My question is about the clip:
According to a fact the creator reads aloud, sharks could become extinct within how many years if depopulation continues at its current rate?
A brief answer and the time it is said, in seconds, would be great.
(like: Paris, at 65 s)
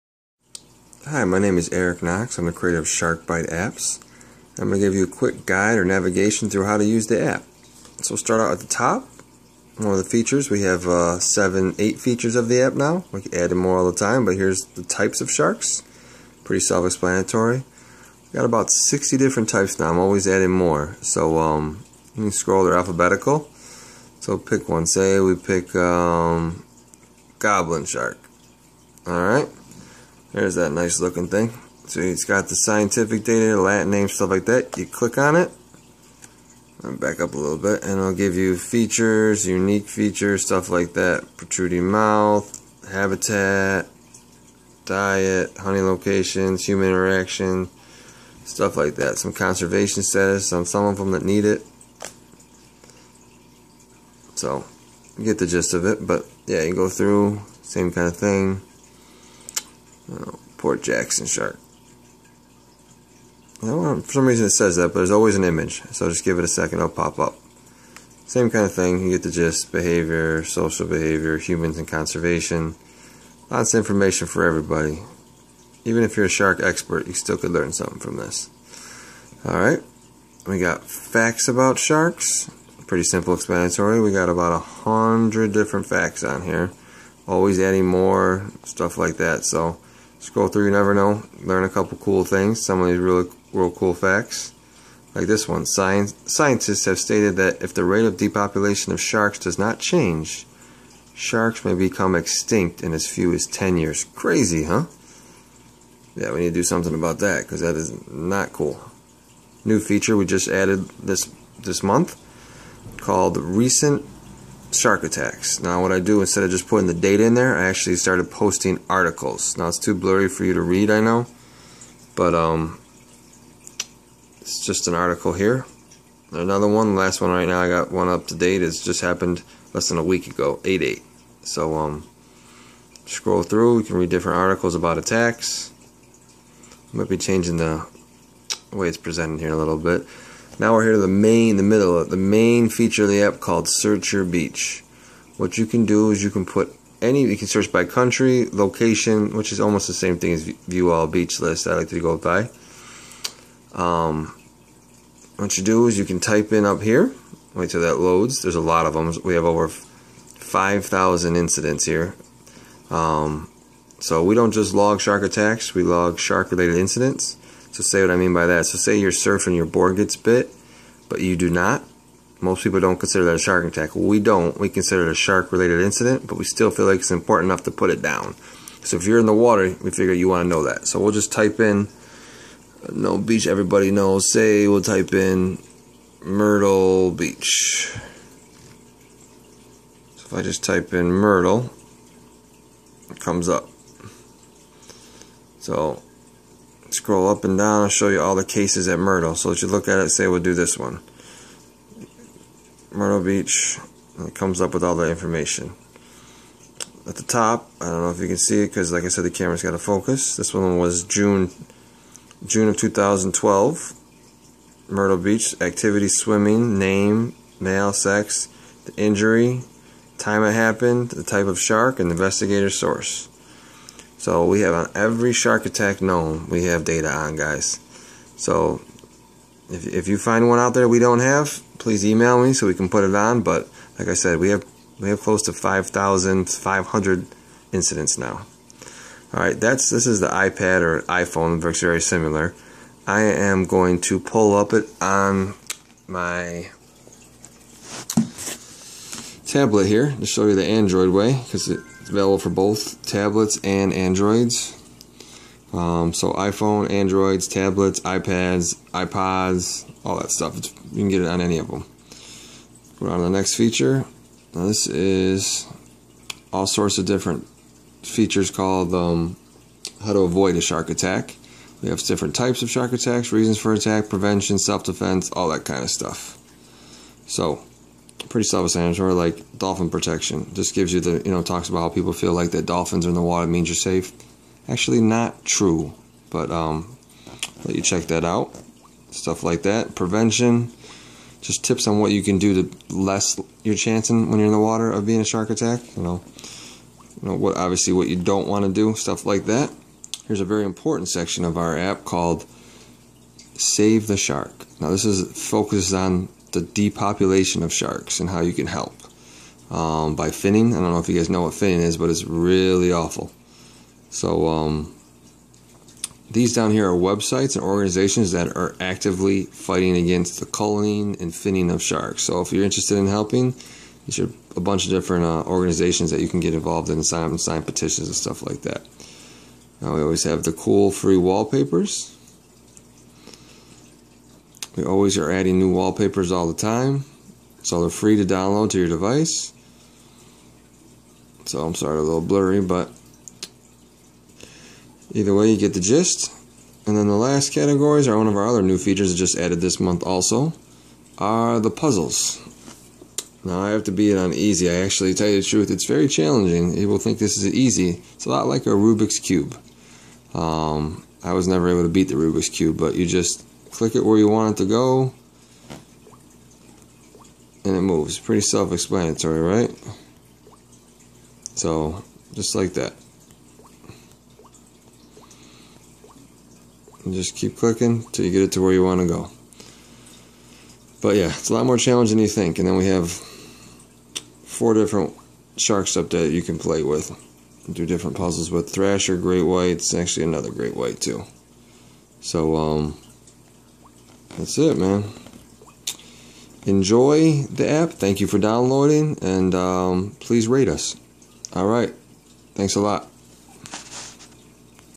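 10 years, at 103 s.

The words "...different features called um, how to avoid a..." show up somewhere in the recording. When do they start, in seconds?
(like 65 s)
267 s.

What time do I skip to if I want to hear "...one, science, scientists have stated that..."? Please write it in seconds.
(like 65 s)
95 s.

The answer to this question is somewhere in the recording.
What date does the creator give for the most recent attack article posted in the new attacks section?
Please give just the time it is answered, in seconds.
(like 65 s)
130 s.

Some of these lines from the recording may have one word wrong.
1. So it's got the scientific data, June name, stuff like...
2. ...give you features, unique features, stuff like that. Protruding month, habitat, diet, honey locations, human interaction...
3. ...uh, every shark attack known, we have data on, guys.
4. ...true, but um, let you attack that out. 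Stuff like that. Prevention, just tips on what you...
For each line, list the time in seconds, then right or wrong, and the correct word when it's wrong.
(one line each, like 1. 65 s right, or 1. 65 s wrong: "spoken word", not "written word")
1. 31 s wrong: "Latin", not "June"
2. 38 s wrong: "mouth", not "month"
3. 224 s right
4. 285 s wrong: "check", not "attack".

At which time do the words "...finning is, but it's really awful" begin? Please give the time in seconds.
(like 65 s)
311 s.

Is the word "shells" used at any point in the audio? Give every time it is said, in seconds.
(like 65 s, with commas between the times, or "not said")
not said.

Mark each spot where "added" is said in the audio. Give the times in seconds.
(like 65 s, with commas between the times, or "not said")
110 s, 349 s.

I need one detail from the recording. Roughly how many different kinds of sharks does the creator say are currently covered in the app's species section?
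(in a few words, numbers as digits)
60.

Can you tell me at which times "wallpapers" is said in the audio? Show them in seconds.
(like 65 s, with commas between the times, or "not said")
331 s, 335 s.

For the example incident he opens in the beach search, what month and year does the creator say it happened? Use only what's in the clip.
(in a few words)
June 2012.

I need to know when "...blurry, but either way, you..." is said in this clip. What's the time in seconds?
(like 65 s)
342 s.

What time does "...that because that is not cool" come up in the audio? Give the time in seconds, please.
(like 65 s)
107 s.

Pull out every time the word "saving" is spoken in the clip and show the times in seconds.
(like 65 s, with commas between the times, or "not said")
not said.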